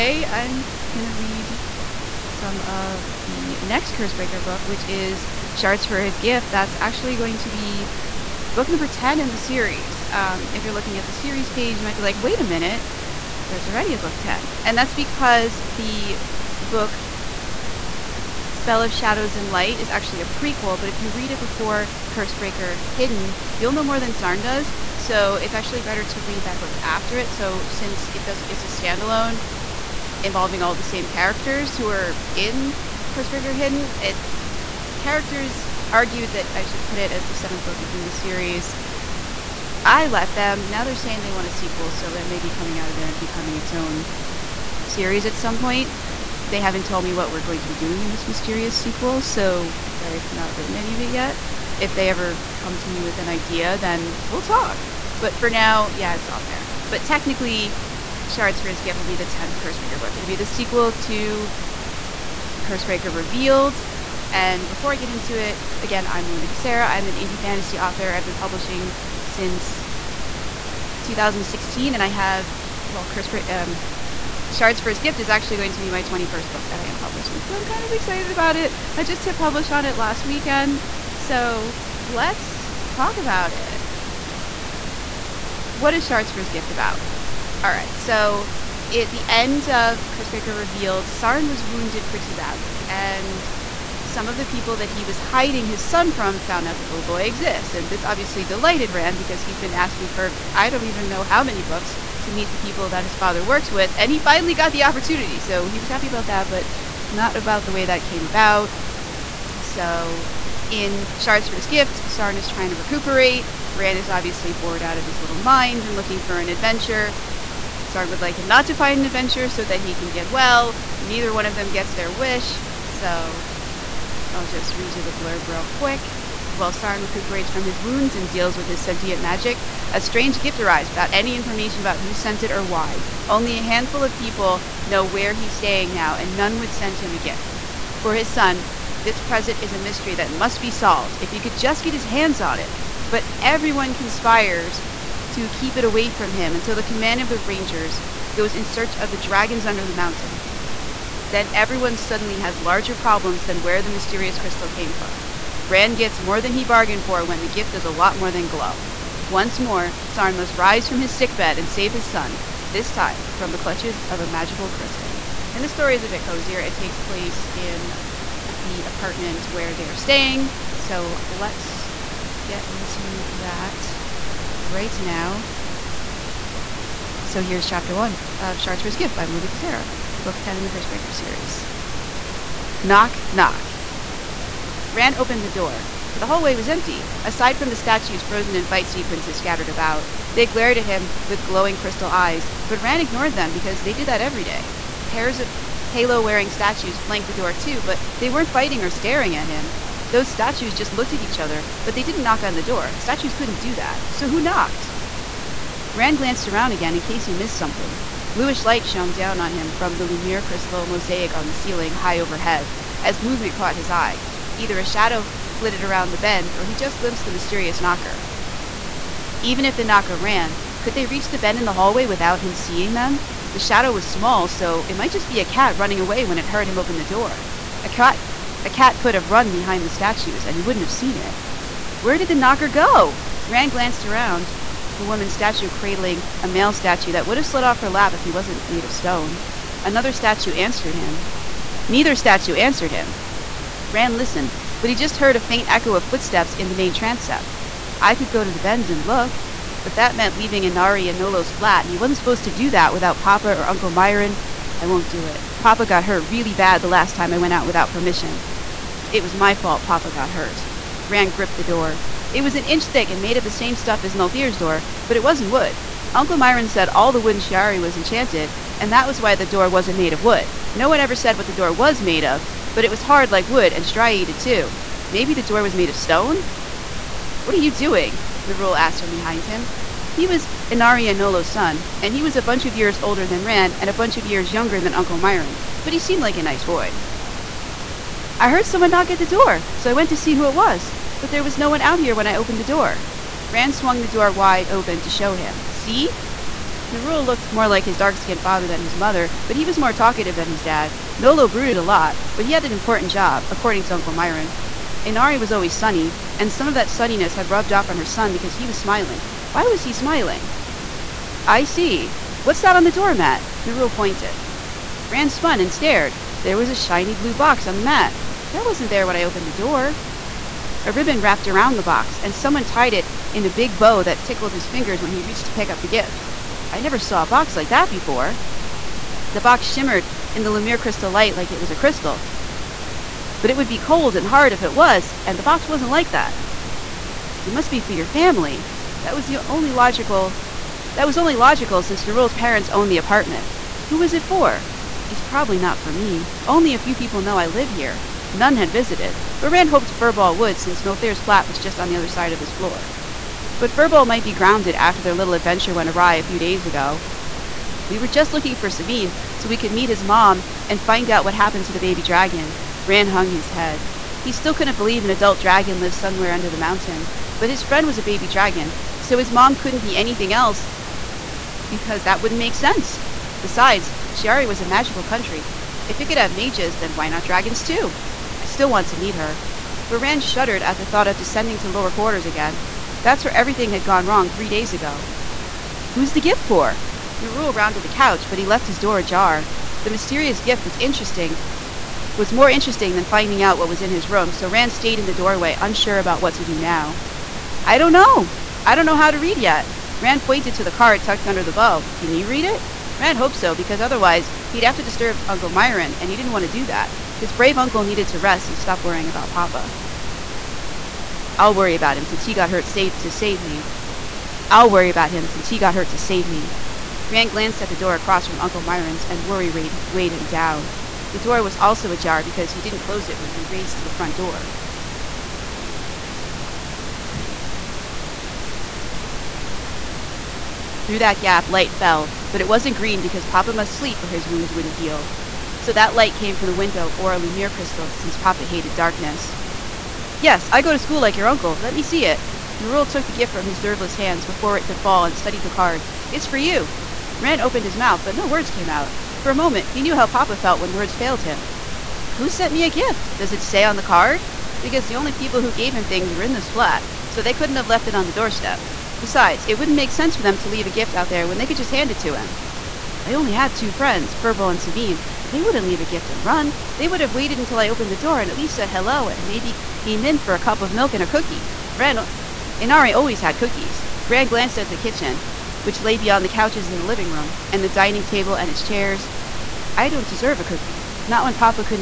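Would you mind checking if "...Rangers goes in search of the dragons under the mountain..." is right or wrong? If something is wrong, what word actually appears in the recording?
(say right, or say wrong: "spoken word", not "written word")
right.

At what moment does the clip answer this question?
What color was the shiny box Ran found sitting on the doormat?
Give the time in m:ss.
5:17.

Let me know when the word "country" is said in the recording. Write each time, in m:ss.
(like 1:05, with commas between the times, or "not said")
6:15.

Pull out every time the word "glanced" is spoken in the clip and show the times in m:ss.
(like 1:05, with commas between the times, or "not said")
3:26, 3:53, 6:57, 7:54.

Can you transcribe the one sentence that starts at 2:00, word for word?
Neither one of them gets their wish.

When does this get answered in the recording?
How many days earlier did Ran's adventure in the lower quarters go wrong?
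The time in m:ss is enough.
6:24.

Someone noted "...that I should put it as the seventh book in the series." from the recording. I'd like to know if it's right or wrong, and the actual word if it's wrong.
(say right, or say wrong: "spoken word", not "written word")
right.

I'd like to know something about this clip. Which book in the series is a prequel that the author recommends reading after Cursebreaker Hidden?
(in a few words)
Spell of Shadows and Light.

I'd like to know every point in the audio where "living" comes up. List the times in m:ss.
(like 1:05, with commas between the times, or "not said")
7:56.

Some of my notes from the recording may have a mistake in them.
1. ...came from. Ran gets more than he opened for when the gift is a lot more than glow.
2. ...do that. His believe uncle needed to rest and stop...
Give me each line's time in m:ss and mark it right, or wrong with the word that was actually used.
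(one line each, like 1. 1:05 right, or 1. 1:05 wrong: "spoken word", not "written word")
1. 2:34 wrong: "bargained", not "opened"
2. 6:46 wrong: "brave", not "believe".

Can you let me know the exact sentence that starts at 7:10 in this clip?
Through that gap, light fell, but it wasn't green because Papa must sleep or his wounds wouldn't heal.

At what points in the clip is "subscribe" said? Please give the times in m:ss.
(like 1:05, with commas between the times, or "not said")
not said.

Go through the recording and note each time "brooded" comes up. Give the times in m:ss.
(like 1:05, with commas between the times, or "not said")
5:01.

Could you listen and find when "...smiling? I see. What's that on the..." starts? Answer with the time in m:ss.
5:09.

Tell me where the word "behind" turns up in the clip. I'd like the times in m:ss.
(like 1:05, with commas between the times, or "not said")
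3:49, 4:39.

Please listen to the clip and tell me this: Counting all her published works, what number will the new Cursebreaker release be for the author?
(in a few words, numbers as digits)
21st.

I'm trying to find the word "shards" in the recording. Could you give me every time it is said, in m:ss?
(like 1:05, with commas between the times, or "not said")
0:05, 0:58, 1:14, 1:26, 1:51, 2:58.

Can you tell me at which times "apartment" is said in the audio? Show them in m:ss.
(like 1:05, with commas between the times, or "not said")
2:48, 5:42.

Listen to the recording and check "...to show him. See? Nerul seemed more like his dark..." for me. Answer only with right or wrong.
wrong.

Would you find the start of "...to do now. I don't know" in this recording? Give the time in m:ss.
6:36.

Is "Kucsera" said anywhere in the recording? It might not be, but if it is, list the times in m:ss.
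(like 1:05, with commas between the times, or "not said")
1:06, 2:59.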